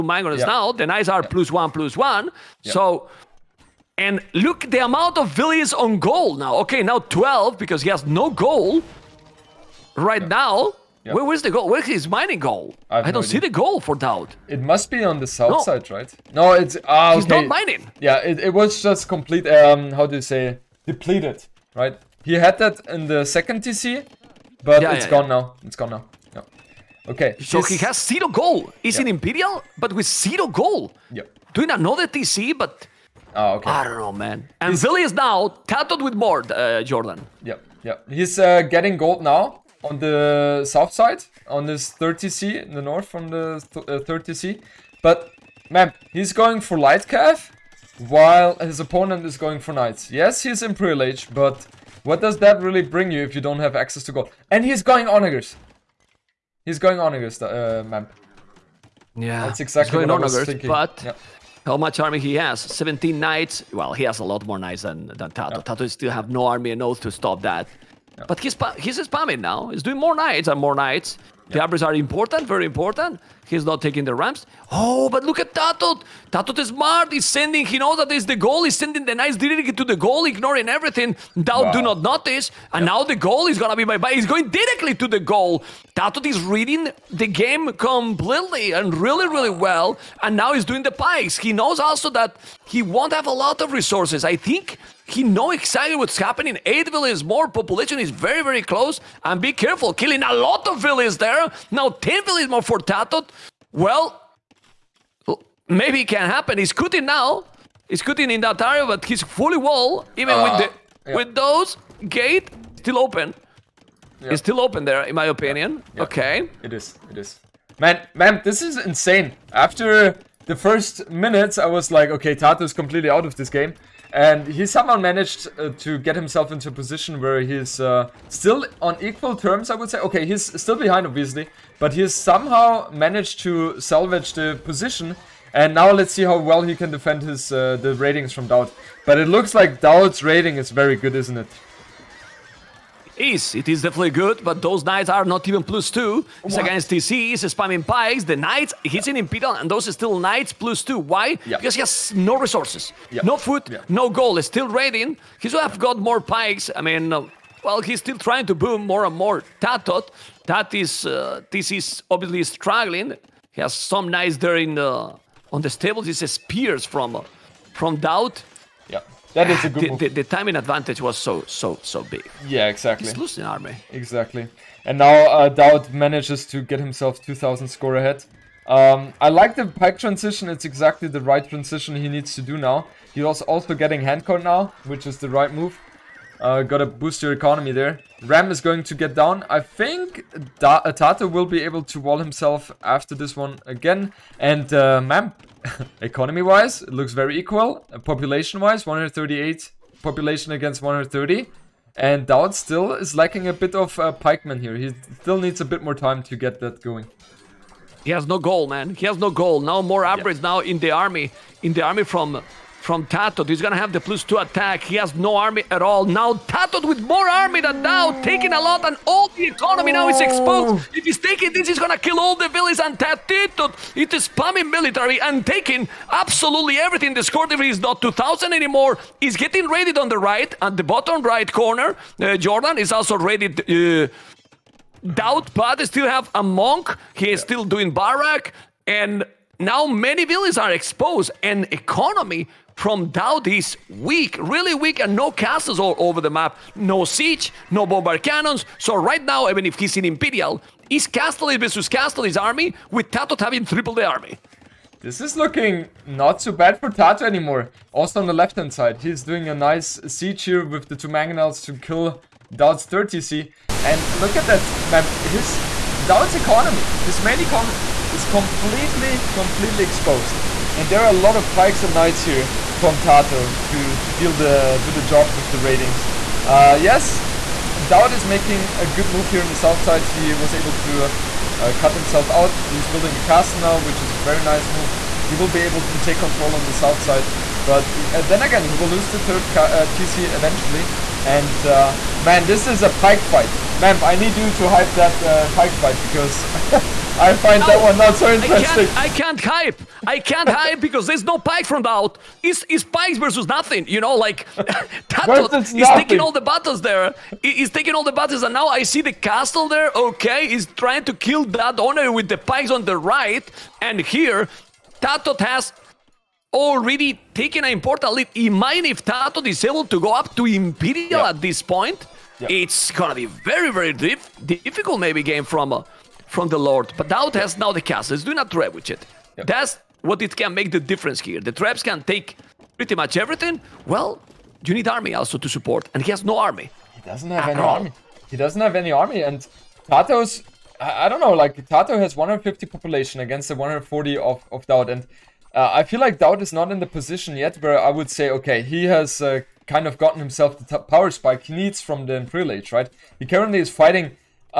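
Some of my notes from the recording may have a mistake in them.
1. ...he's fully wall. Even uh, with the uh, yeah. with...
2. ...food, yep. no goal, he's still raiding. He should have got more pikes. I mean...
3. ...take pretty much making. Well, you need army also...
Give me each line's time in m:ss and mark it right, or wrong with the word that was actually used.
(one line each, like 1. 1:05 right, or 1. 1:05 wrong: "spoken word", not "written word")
1. 1:49 right
2. 2:33 right
3. 5:32 wrong: "everything", not "making".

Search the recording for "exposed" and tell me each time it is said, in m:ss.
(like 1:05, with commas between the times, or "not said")
3:40, 4:00, 4:29.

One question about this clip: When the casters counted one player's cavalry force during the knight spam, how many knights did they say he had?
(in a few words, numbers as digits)
17.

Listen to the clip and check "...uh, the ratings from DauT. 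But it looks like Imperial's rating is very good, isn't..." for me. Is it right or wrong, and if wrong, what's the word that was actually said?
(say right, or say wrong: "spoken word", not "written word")
wrong: "DauT", not "Imperial".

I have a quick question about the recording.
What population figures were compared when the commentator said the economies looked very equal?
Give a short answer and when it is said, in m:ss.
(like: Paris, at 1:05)
138 against 130, at 3:18.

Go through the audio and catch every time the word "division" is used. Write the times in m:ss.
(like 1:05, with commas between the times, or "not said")
3:47.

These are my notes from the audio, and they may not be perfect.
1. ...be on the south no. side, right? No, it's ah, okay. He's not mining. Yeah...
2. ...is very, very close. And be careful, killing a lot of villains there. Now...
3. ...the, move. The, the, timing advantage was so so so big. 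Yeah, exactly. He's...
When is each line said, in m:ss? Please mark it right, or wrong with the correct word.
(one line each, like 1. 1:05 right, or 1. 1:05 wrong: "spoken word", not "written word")
1. 0:14 right
2. 1:37 right
3. 2:49 right.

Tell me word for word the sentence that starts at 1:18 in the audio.
He's sending the knights directly to the goal, ignoring everything.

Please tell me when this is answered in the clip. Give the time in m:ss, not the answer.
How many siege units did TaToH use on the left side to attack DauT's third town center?
4:20.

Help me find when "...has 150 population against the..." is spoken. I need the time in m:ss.
5:42.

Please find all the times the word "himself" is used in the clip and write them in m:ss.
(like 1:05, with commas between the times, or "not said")
2:06, 2:56, 3:12, 4:41, 5:50.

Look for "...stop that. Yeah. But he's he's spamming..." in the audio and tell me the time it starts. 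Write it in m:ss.
1:07.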